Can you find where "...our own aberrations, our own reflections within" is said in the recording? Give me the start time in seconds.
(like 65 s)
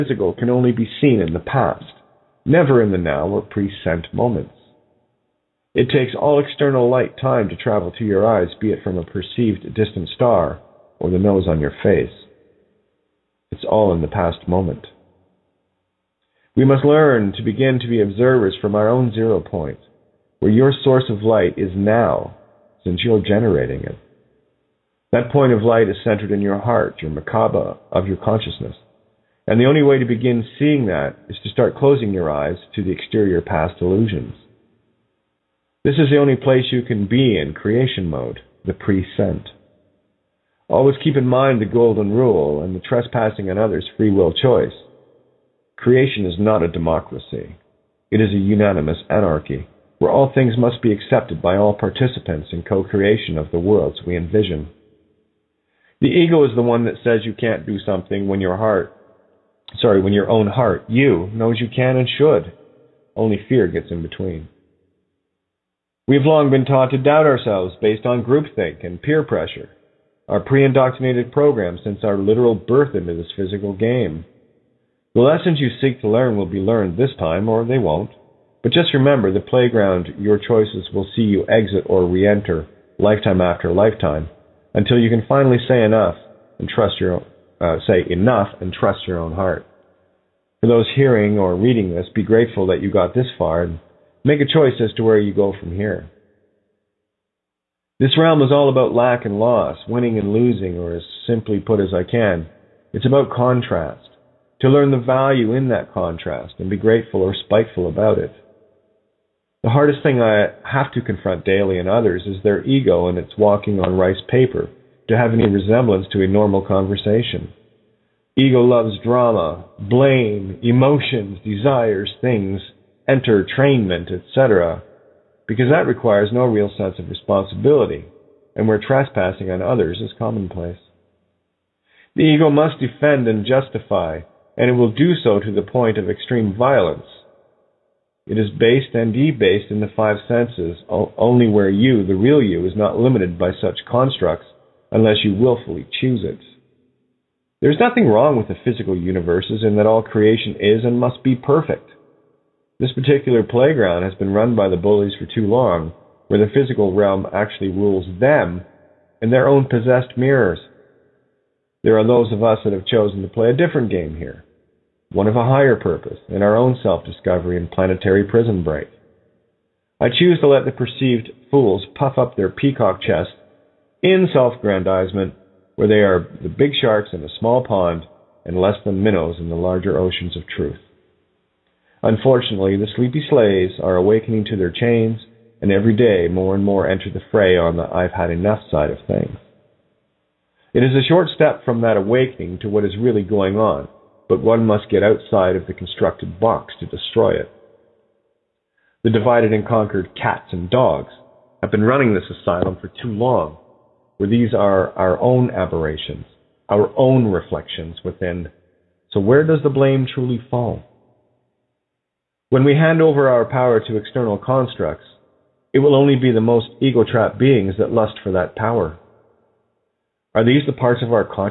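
204 s.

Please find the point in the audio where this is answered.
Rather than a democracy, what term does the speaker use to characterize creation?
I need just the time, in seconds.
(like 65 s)
48 s.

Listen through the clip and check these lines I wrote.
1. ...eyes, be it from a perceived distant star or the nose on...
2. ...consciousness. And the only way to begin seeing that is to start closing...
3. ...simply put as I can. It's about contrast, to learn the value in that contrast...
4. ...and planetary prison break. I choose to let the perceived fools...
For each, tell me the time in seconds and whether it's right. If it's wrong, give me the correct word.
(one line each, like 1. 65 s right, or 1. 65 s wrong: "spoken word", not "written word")
1. 8 s right
2. 28 s right
3. 101 s right
4. 167 s right.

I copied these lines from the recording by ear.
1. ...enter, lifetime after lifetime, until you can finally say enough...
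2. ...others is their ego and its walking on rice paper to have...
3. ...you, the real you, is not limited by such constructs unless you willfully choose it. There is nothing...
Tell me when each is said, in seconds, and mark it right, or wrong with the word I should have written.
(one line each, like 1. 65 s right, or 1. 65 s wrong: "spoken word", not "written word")
1. 82 s right
2. 111 s right
3. 141 s right.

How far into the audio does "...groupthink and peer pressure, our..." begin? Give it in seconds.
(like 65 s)
68 s.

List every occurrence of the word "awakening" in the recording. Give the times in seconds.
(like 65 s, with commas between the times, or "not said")
183 s, 191 s.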